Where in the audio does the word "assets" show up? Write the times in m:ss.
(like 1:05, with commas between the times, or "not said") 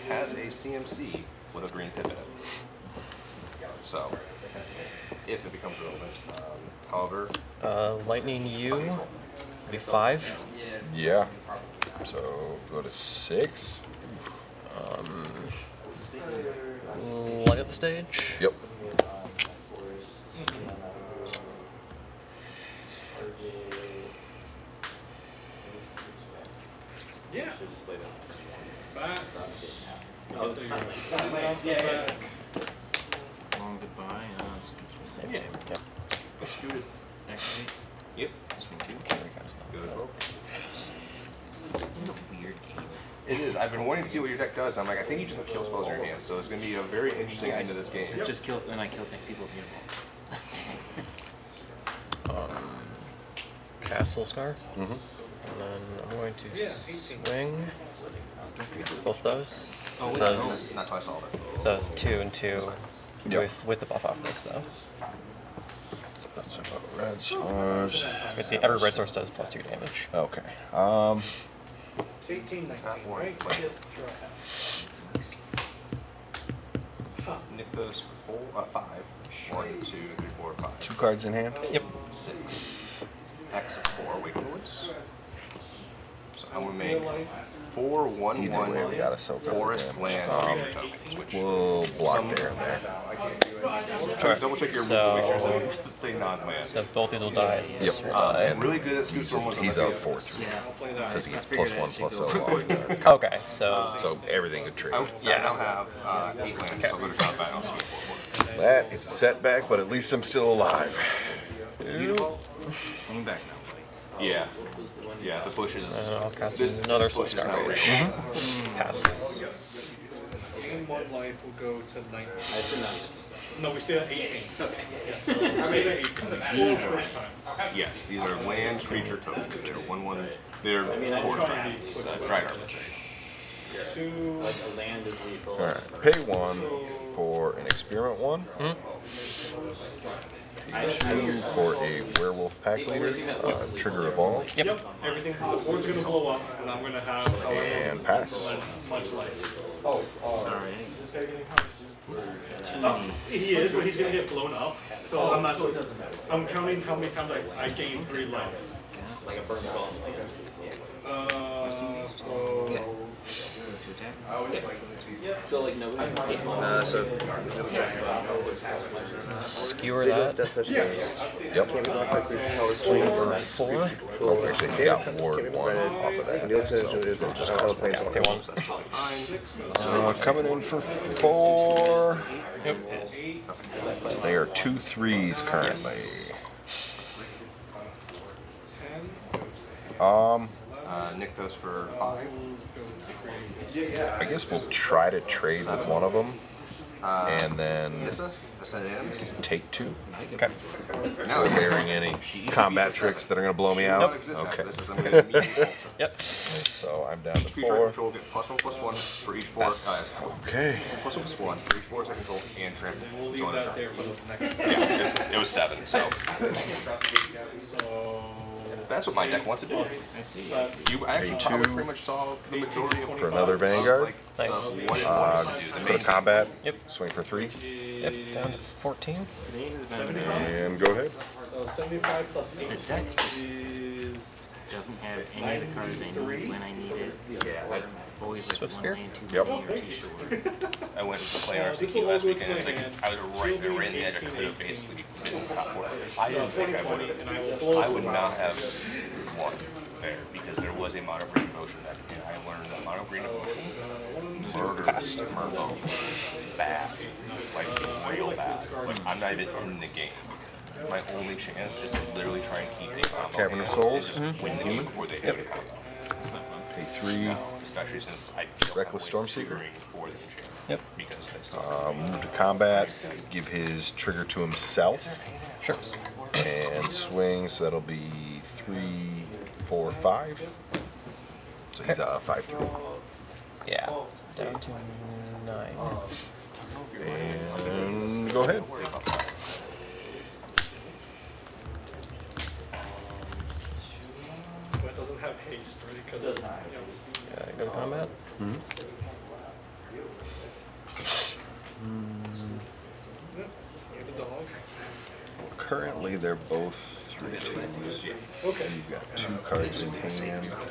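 not said.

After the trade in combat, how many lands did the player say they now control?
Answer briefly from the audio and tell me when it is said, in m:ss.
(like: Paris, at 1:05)
8, at 1:46.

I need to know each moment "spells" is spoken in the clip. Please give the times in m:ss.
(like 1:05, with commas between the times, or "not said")
0:45, 2:39.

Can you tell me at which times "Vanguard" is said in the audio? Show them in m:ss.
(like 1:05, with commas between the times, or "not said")
3:43.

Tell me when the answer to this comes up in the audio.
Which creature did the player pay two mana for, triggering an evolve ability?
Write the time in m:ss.
2:22.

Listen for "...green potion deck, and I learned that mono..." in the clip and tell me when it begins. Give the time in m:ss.
4:11.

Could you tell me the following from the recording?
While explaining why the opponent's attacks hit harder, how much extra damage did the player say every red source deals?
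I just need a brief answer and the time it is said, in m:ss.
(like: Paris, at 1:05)
2, at 1:08.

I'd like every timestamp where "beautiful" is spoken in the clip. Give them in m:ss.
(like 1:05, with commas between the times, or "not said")
0:49.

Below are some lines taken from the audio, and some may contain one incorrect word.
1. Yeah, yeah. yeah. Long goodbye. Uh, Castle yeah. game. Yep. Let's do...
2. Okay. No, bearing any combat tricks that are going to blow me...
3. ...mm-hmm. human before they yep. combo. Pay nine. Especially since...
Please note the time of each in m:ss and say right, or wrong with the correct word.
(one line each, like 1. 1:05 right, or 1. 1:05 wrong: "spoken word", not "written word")
1. 0:31 wrong: "Same", not "Castle"
2. 3:20 right
3. 4:24 wrong: "three", not "nine".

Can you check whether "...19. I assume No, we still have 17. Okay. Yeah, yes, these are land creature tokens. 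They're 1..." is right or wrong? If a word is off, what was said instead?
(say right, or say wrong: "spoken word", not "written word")
wrong: "18", not "17".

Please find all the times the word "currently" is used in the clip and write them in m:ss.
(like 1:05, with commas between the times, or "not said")
3:05, 5:05.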